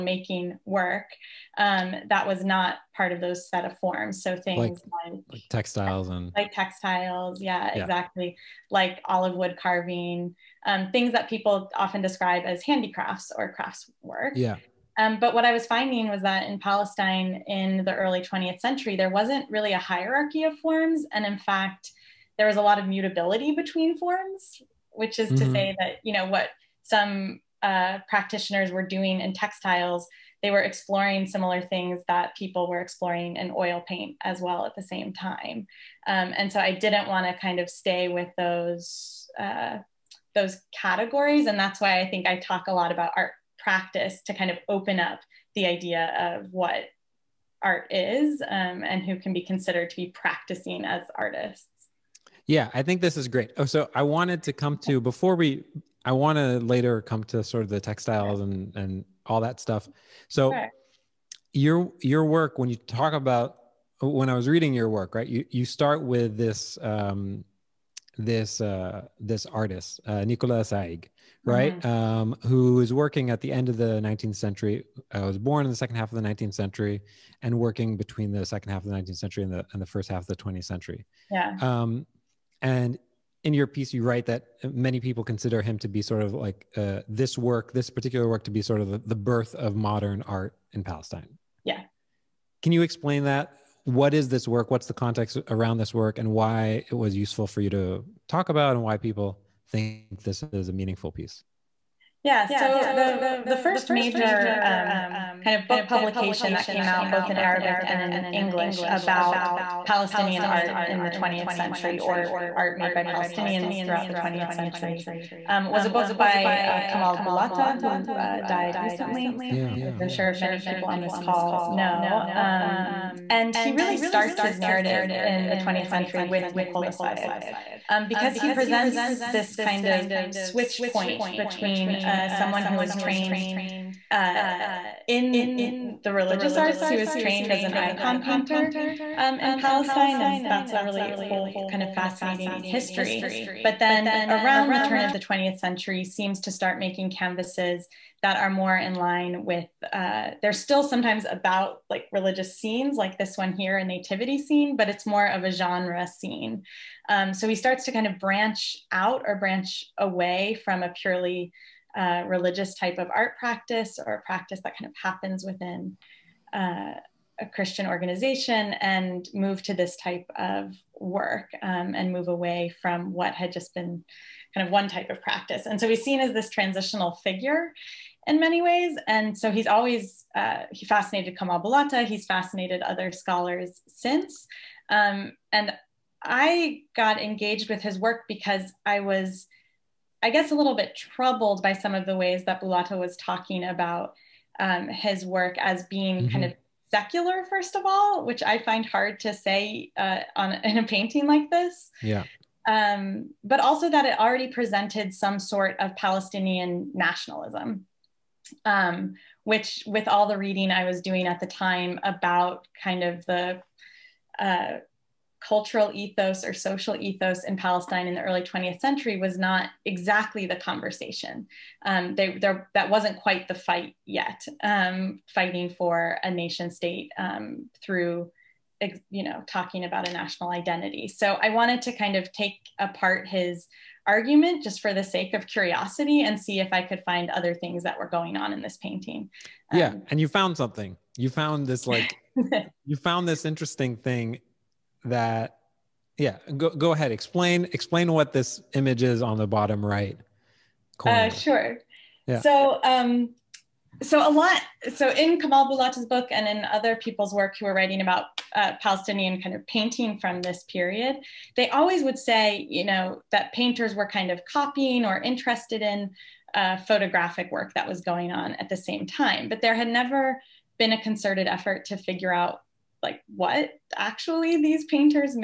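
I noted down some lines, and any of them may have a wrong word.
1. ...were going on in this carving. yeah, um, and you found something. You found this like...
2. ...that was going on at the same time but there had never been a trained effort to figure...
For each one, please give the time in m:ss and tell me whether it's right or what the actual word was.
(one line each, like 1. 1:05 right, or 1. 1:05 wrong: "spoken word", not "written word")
1. 3:57 wrong: "painting", not "carving"
2. 4:27 wrong: "concerted", not "trained".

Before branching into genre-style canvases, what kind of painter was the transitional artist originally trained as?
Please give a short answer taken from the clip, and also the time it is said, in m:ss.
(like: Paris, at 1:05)
Icon painter, at 2:17.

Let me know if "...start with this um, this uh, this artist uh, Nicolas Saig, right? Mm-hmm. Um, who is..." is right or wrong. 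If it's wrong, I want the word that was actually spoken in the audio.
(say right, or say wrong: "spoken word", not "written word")
right.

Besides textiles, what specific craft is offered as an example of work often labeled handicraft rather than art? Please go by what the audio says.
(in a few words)
Olive wood carving.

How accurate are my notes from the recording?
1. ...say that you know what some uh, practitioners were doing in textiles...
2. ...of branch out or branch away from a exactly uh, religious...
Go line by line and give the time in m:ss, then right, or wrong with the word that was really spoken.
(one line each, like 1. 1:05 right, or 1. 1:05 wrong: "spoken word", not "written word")
1. 0:25 right
2. 2:38 wrong: "purely", not "exactly".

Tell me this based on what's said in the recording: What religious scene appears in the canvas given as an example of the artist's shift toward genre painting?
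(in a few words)
A nativity scene.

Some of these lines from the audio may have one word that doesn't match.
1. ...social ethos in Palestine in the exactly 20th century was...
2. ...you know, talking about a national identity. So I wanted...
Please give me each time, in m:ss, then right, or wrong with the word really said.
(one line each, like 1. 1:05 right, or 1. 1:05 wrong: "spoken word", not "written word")
1. 3:36 wrong: "early", not "exactly"
2. 3:49 right.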